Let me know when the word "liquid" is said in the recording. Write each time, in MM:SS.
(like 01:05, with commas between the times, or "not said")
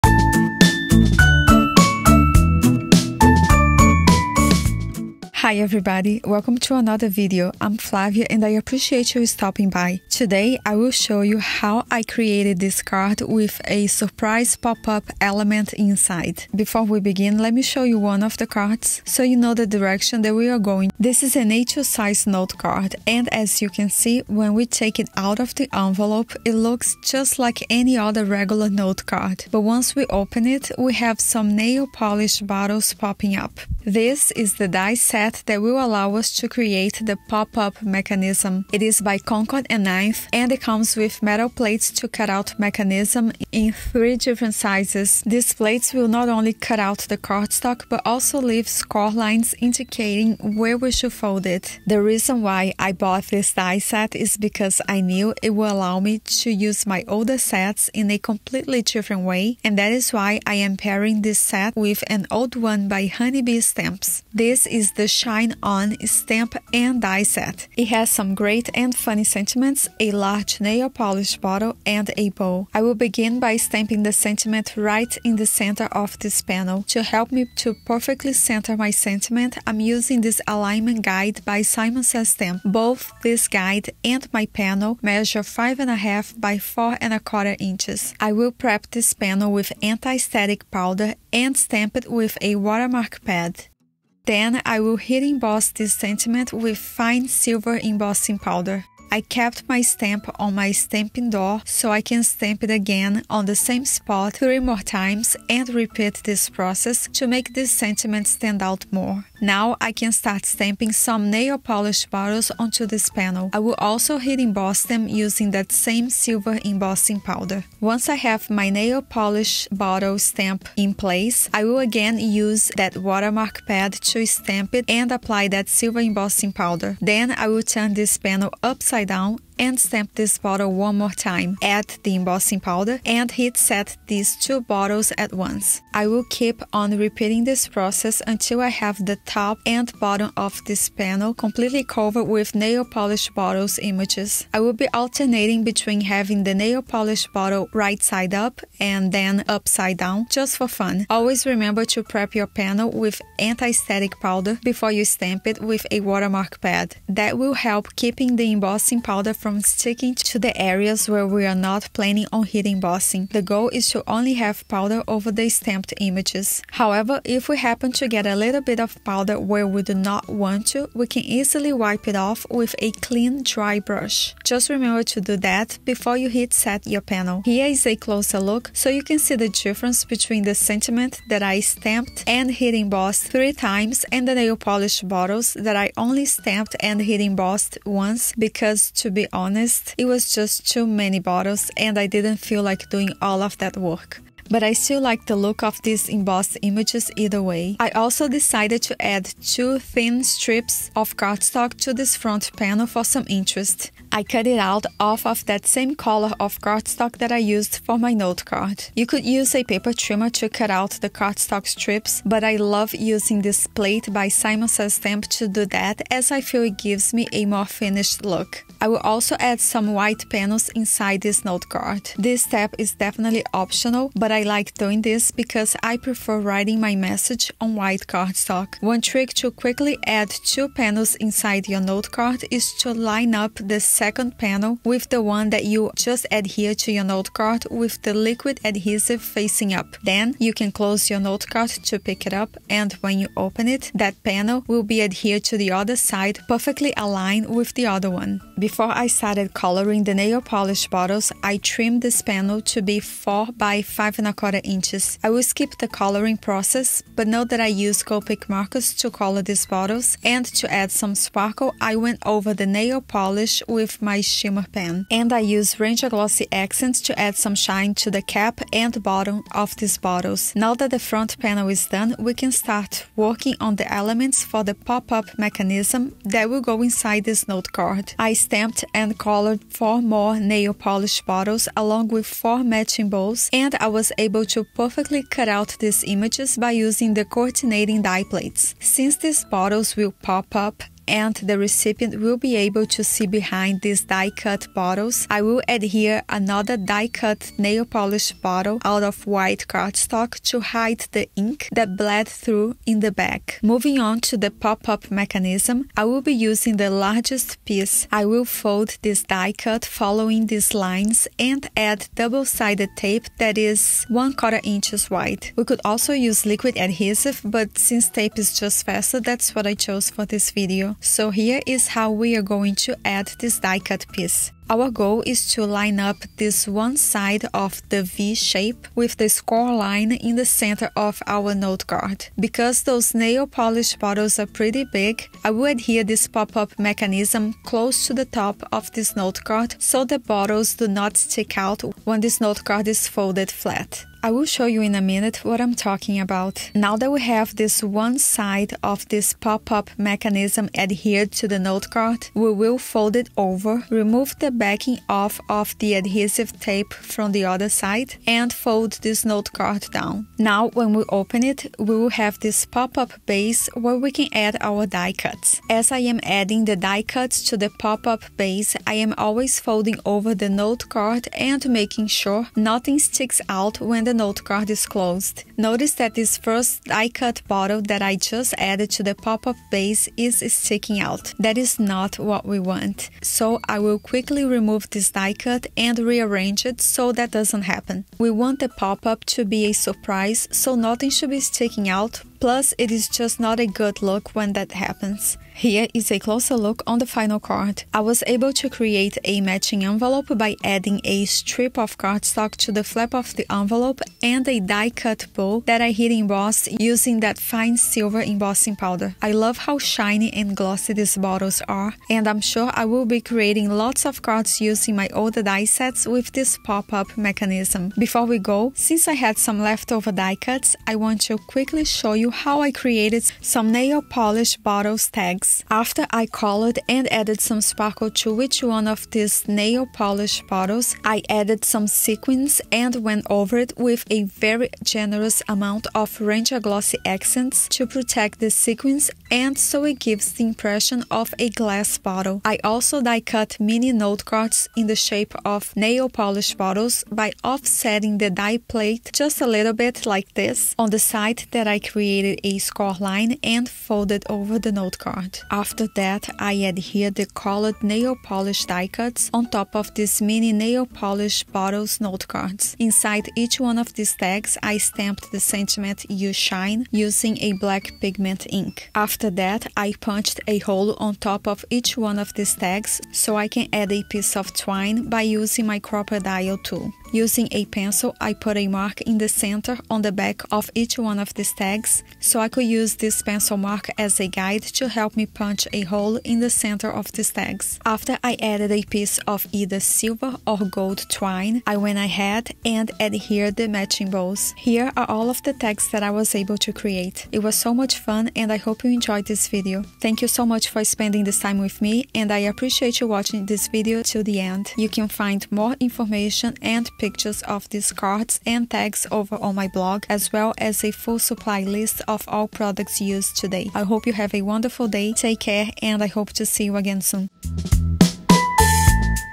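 03:58, 05:16.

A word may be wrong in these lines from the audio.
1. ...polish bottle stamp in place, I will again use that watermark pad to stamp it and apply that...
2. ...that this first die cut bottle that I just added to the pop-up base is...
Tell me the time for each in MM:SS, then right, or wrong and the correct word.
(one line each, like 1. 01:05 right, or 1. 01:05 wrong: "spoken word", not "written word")
1. 01:59 right
2. 06:15 right.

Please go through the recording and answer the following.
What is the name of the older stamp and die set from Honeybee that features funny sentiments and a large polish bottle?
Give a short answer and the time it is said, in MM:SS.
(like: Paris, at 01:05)
Shine On, at 01:05.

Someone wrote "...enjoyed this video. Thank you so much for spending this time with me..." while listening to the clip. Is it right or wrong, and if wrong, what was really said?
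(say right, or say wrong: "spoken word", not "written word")
right.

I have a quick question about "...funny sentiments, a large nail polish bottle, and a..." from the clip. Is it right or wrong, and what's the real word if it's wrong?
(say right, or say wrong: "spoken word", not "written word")
right.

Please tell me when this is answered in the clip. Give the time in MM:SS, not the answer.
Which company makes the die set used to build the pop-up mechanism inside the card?
00:39.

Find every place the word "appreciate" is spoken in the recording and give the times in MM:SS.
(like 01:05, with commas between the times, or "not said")
00:08, 08:22.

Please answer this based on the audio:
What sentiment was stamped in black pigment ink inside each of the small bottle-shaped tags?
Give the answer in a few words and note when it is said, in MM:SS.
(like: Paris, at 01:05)
You shine, at 07:46.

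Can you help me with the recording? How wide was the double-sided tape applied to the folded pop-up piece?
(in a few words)
1/4 inch.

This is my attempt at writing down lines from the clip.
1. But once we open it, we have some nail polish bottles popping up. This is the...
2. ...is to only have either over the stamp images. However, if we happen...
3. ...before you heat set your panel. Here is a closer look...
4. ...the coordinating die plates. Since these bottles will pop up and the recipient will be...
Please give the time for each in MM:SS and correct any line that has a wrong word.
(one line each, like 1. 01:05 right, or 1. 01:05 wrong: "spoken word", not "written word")
1. 00:29 right
2. 02:43 wrong: "powder", not "either"
3. 02:55 right
4. 04:47 right.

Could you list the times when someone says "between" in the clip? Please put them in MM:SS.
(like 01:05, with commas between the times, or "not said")
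02:25, 03:00.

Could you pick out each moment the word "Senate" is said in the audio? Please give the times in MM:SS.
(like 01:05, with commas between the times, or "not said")
not said.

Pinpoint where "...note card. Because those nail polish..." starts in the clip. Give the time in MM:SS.
05:31.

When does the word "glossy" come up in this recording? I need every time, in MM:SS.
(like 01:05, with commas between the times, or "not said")
04:26, 06:50, 07:16.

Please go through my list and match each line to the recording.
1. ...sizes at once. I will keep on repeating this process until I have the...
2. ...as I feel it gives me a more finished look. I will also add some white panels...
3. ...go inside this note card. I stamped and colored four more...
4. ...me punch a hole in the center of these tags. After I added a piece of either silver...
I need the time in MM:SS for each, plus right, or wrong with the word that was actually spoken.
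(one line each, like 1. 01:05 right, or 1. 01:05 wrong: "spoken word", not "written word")
1. 02:14 wrong: "bottles", not "sizes"
2. 03:36 right
3. 04:36 right
4. 08:05 right.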